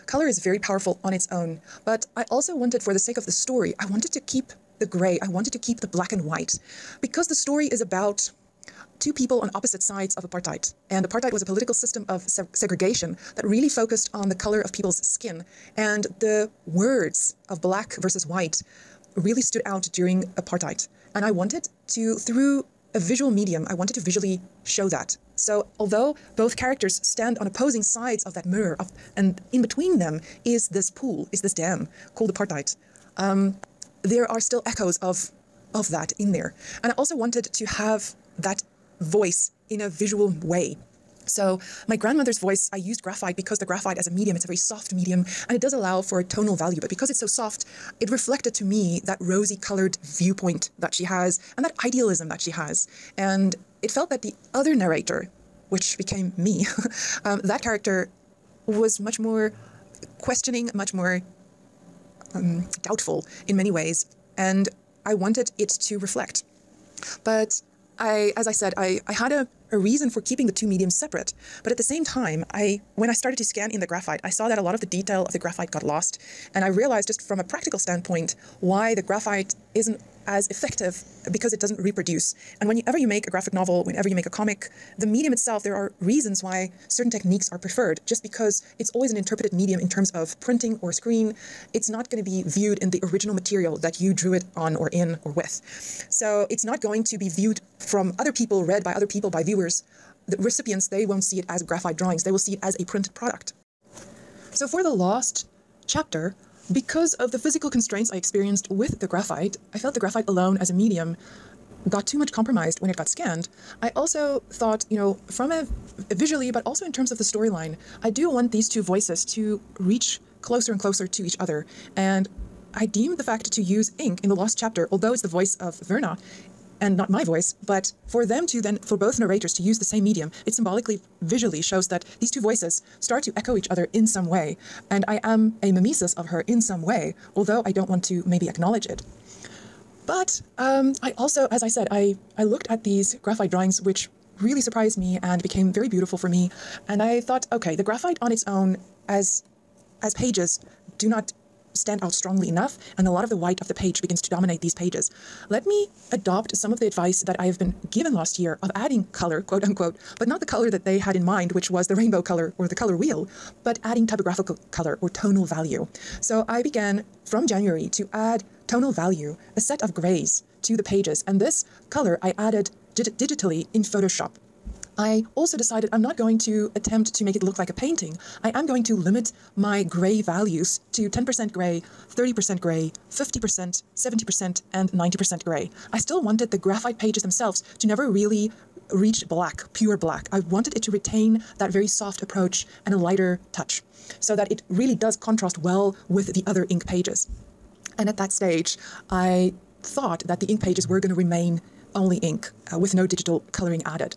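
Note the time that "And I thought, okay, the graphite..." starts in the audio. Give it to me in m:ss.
2:26.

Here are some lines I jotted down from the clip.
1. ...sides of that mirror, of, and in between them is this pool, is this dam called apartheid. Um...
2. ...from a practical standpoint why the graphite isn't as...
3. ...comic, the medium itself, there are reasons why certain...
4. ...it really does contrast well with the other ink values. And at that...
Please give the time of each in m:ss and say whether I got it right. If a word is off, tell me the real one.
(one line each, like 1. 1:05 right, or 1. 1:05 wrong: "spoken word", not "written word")
1. 0:27 right
2. 1:17 right
3. 1:24 right
4. 3:14 wrong: "pages", not "values".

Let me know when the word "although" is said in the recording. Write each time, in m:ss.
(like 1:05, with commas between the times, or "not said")
0:25, 2:04, 2:17.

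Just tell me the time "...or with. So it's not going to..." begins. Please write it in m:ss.
1:35.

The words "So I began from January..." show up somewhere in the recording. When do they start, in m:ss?
2:46.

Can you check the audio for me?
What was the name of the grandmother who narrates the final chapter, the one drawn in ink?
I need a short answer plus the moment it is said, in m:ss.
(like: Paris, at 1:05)
Verna, at 2:05.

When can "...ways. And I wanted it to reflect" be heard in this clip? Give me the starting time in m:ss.
1:03.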